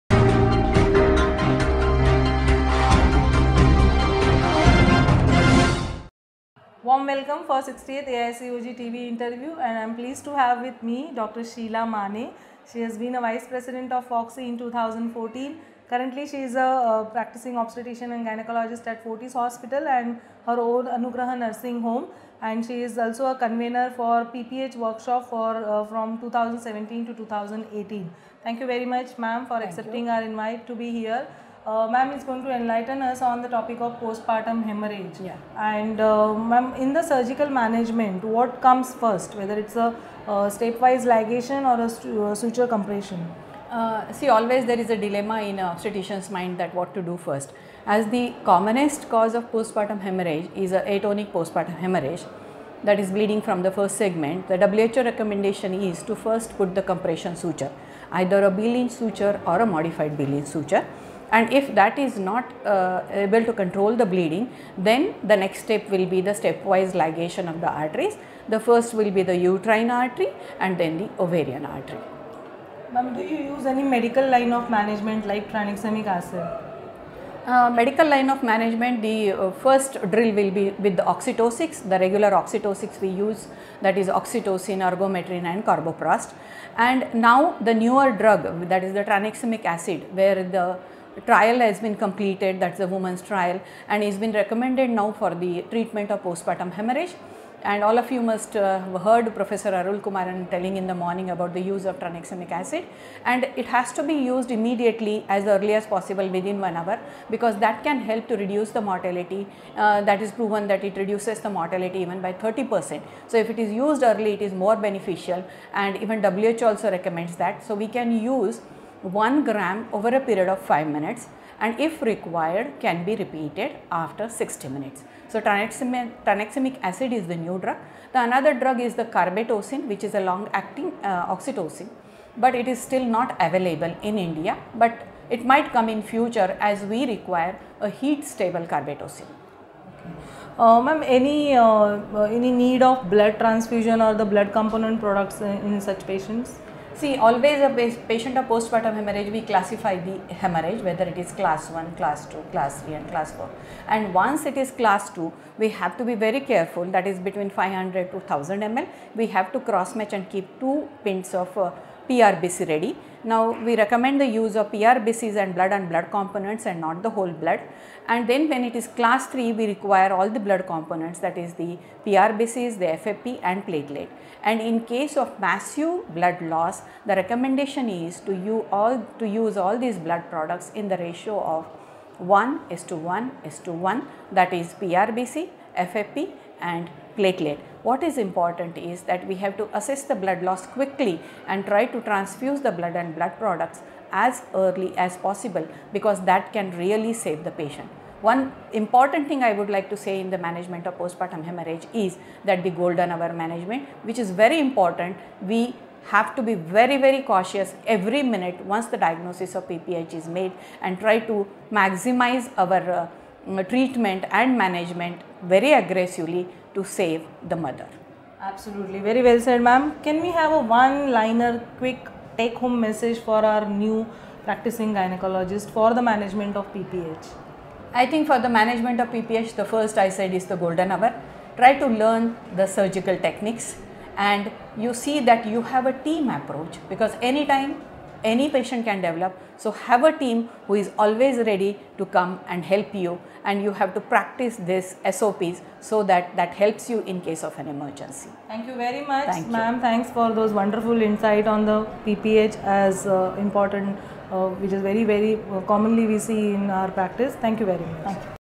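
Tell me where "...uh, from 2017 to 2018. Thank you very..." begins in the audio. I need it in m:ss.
0:25.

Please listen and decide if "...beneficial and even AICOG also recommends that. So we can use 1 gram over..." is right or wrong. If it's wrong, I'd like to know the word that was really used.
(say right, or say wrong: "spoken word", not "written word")
wrong: "WHO", not "AICOG".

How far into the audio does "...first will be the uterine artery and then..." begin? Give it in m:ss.
1:08.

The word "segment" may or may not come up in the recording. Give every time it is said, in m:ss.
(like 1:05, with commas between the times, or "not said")
0:53.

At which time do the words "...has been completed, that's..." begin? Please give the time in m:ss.
1:31.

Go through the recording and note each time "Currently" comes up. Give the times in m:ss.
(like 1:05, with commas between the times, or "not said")
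0:15.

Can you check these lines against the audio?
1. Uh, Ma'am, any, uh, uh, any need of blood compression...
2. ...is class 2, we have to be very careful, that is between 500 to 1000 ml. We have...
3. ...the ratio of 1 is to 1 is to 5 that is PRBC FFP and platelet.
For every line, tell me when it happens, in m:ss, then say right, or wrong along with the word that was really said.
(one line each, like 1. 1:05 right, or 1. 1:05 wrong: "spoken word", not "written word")
1. 2:20 wrong: "transfusion", not "compression"
2. 2:34 right
3. 3:00 wrong: "1", not "5".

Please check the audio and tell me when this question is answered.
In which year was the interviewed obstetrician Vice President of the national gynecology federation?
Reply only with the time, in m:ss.
0:14.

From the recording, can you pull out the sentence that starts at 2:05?
So tranexamic, acid is the new drug.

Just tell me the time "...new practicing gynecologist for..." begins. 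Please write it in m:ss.
3:43.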